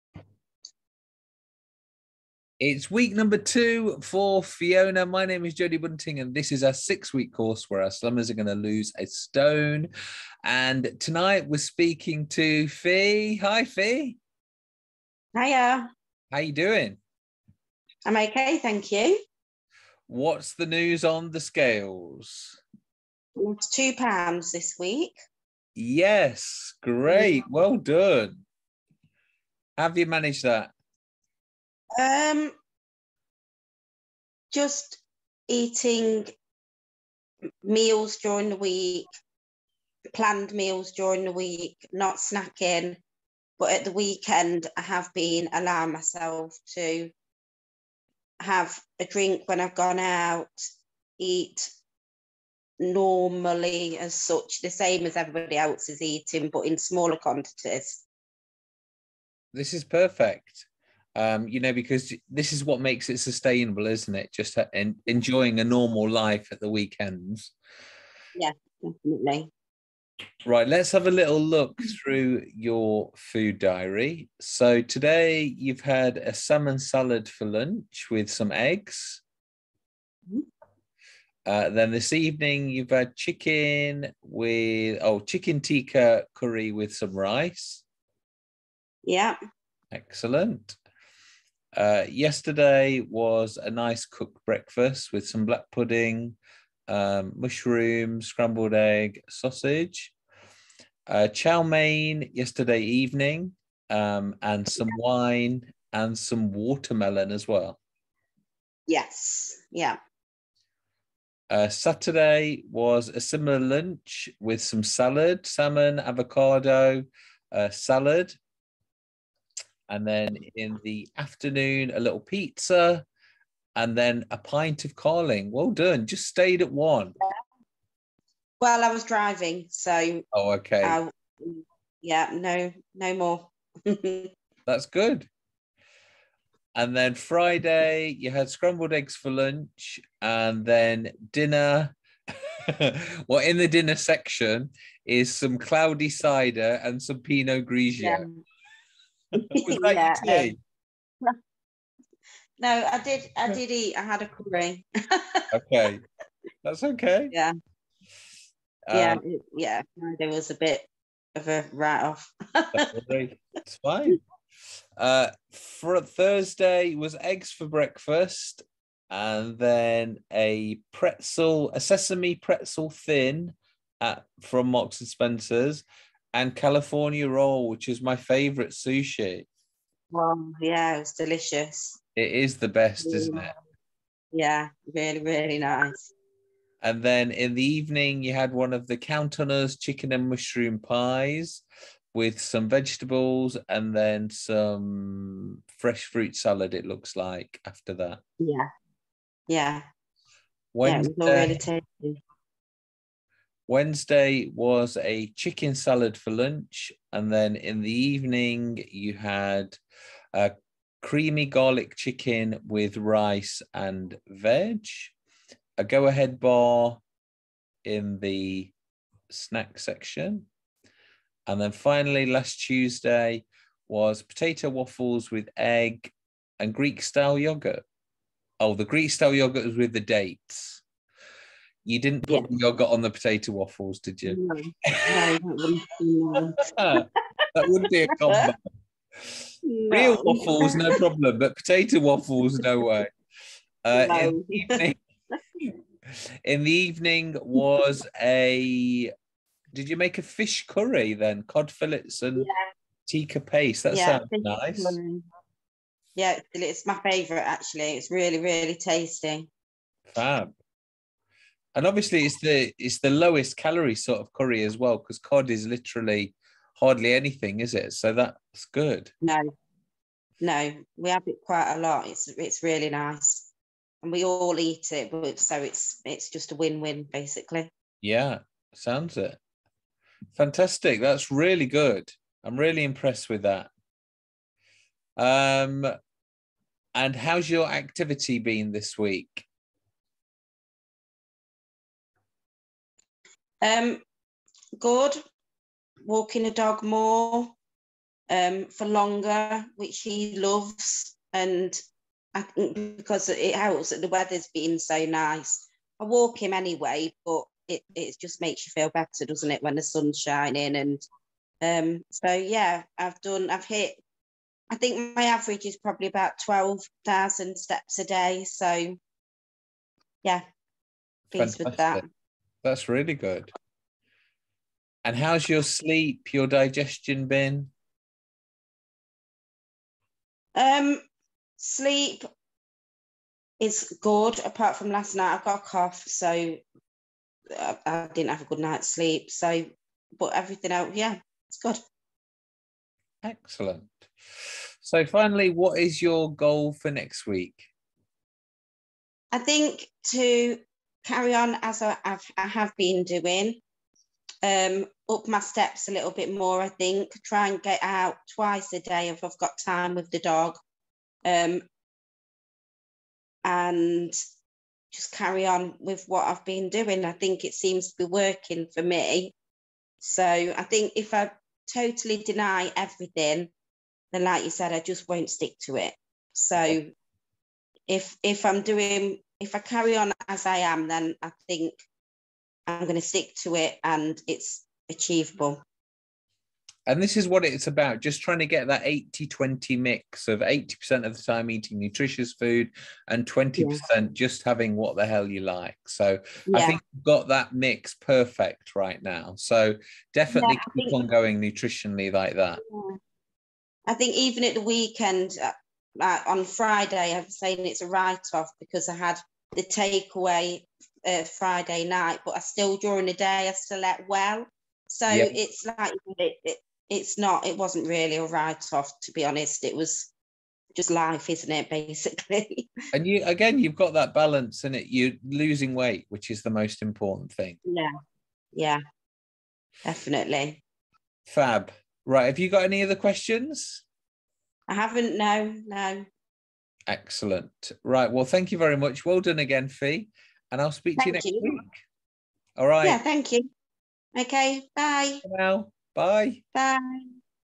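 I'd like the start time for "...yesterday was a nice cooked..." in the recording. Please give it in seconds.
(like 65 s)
92 s.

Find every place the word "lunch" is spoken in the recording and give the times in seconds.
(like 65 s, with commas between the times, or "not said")
77 s, 113 s, 139 s, 206 s.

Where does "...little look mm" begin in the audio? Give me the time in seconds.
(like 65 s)
71 s.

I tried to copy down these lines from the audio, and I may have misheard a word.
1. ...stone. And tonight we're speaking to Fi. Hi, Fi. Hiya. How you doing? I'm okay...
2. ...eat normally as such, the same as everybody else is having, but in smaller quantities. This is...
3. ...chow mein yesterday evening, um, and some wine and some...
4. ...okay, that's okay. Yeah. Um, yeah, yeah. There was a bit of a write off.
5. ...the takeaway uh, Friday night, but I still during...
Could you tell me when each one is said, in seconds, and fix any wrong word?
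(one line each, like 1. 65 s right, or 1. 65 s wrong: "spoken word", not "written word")
1. 9 s right
2. 51 s wrong: "eating", not "having"
3. 101 s right
4. 155 s right
5. 409 s right.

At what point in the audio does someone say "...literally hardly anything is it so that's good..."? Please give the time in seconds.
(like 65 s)
265 s.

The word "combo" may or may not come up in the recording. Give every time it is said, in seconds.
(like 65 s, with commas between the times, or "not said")
238 s.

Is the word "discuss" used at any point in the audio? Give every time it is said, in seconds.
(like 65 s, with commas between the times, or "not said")
not said.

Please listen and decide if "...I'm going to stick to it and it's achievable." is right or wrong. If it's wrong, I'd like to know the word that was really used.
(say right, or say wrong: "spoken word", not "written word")
right.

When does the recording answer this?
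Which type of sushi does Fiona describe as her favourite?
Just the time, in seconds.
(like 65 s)
176 s.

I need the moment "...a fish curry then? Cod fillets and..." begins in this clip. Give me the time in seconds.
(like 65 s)
250 s.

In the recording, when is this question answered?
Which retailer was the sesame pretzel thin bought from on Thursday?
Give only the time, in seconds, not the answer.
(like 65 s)
174 s.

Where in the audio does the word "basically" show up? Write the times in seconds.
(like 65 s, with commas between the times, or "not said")
277 s, 421 s.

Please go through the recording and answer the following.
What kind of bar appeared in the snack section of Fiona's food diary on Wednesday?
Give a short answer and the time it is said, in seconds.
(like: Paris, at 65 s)
Go Ahead bar, at 215 s.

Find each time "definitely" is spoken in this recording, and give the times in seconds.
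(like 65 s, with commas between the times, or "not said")
68 s, 400 s, 429 s.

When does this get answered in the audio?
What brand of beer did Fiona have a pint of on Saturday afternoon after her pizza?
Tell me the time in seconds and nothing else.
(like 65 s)
124 s.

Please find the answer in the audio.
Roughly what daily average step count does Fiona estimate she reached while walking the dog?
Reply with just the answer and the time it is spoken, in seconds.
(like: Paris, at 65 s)
12,000 steps, at 316 s.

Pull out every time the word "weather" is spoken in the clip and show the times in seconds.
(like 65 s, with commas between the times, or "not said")
304 s.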